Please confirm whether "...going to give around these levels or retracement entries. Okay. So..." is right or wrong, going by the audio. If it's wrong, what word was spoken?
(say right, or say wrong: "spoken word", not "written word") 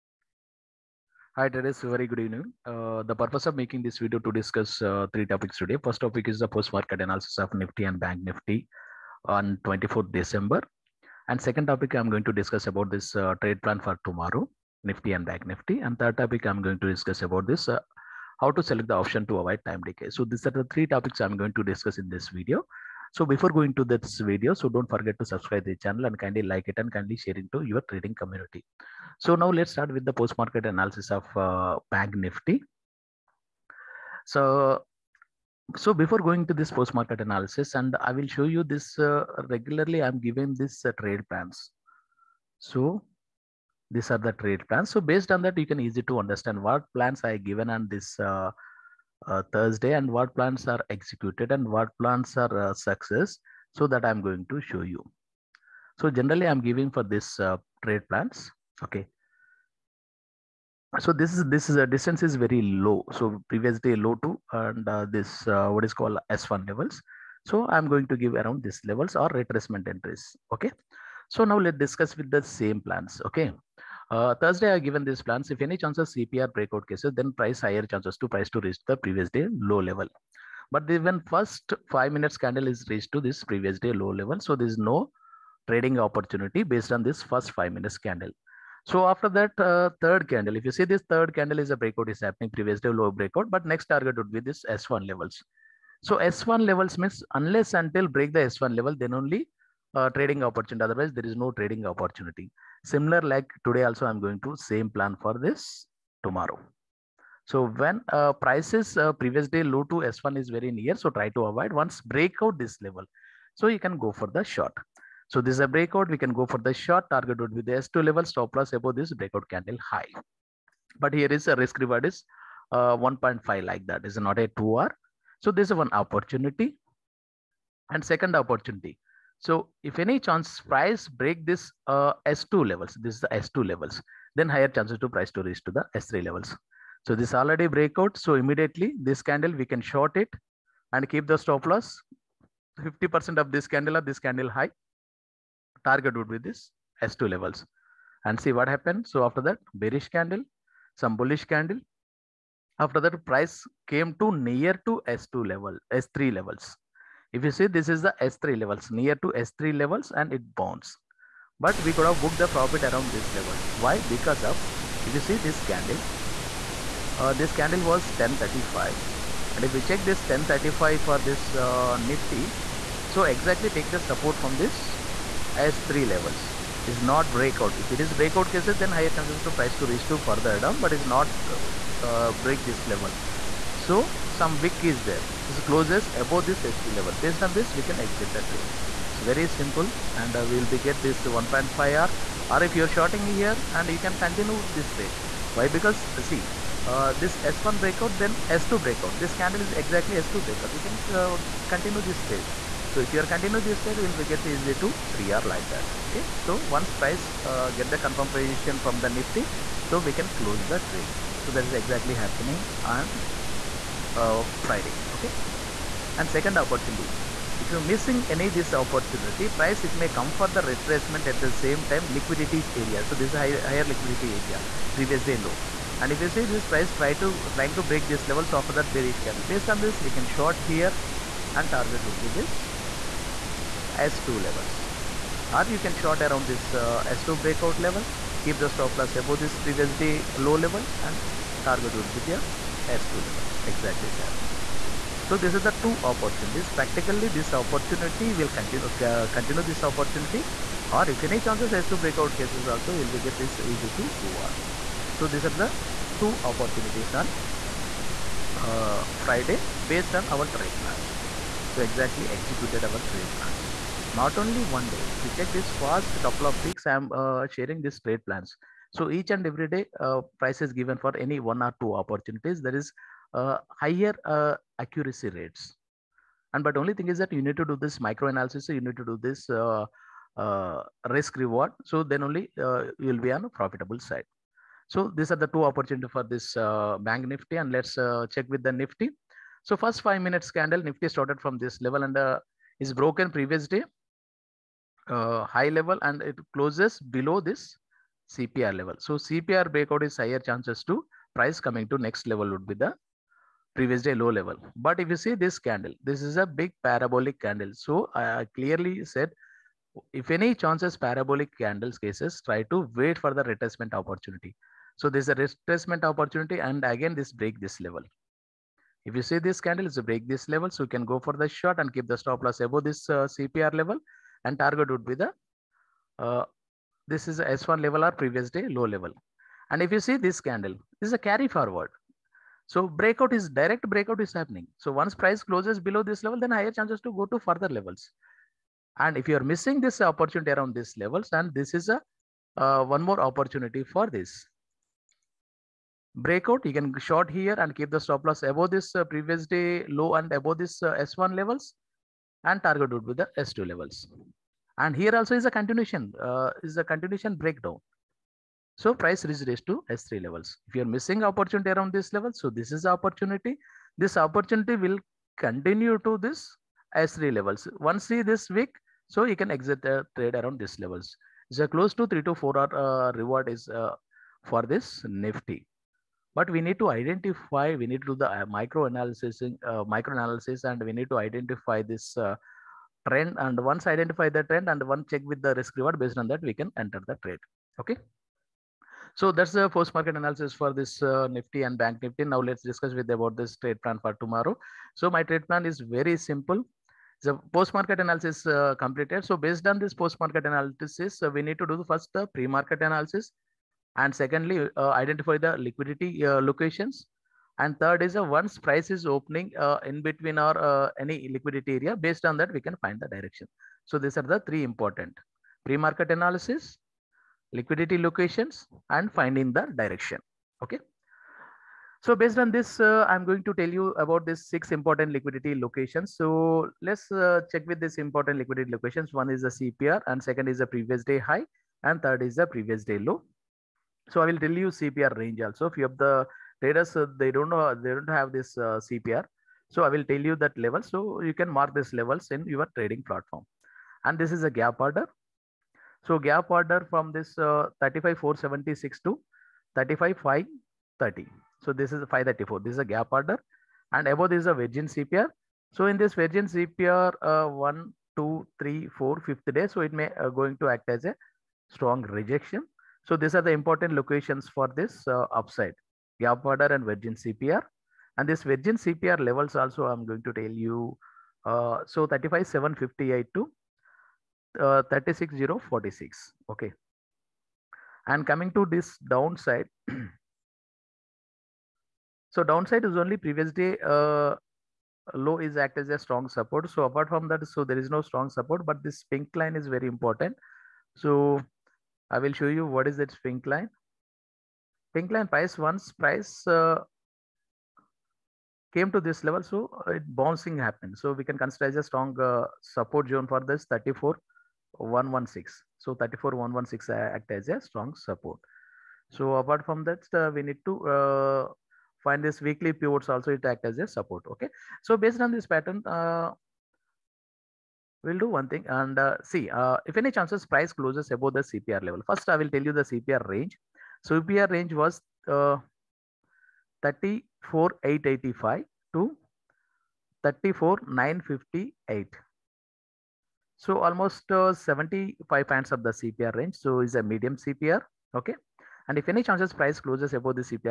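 right.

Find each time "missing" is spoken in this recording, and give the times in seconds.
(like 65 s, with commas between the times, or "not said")
217 s, 339 s, 360 s.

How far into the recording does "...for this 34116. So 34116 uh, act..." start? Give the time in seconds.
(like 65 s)
503 s.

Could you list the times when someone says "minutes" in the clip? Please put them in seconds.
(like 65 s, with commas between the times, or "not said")
82 s, 87 s, 290 s.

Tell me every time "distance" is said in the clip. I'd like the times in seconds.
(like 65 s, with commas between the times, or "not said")
61 s.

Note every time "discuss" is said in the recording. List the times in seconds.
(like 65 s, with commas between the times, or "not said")
4 s, 12 s, 16 s, 21 s, 71 s, 392 s.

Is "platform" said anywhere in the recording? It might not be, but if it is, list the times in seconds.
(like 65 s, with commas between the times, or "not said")
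443 s.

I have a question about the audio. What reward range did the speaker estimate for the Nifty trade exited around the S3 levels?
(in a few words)
three to four.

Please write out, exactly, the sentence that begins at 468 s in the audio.
And this virgin CPR levels also I'm going to tell you.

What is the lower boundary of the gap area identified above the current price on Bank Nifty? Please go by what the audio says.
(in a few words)
35476.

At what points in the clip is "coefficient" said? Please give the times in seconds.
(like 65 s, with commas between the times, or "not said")
not said.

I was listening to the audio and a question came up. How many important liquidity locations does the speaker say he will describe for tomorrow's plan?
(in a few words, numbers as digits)
6.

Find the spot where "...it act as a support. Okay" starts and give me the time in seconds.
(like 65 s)
513 s.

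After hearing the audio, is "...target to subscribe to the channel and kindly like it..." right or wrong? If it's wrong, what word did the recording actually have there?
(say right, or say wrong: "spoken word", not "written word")
wrong: "forget", not "target".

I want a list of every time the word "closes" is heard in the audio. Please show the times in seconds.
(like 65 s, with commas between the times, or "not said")
185 s, 210 s, 296 s, 335 s, 371 s, 520 s, 539 s.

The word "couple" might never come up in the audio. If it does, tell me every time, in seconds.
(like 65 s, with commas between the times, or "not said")
266 s.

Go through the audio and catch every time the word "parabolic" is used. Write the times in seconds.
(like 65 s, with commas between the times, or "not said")
306 s, 310 s.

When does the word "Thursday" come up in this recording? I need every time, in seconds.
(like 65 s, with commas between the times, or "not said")
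49 s, 74 s.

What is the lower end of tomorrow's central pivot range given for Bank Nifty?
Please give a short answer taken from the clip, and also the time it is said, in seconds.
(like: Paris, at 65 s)
34885, at 526 s.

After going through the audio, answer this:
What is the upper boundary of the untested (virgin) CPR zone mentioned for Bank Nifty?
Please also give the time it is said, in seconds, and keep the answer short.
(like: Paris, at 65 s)
36046, at 474 s.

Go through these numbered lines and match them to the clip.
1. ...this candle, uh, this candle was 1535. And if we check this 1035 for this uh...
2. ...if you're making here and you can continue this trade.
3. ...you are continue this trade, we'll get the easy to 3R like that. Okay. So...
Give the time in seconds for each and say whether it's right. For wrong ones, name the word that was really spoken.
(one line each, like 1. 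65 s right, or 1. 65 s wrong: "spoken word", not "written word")
1. 165 s wrong: "1035", not "1535"
2. 192 s wrong: "shorting", not "making"
3. 203 s right.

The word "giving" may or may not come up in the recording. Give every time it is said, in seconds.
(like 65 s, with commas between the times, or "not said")
40 s, 56 s.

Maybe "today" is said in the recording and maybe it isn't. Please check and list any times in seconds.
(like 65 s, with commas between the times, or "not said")
5 s, 103 s.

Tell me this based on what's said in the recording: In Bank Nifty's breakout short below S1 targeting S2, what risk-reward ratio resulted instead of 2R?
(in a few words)
1.5.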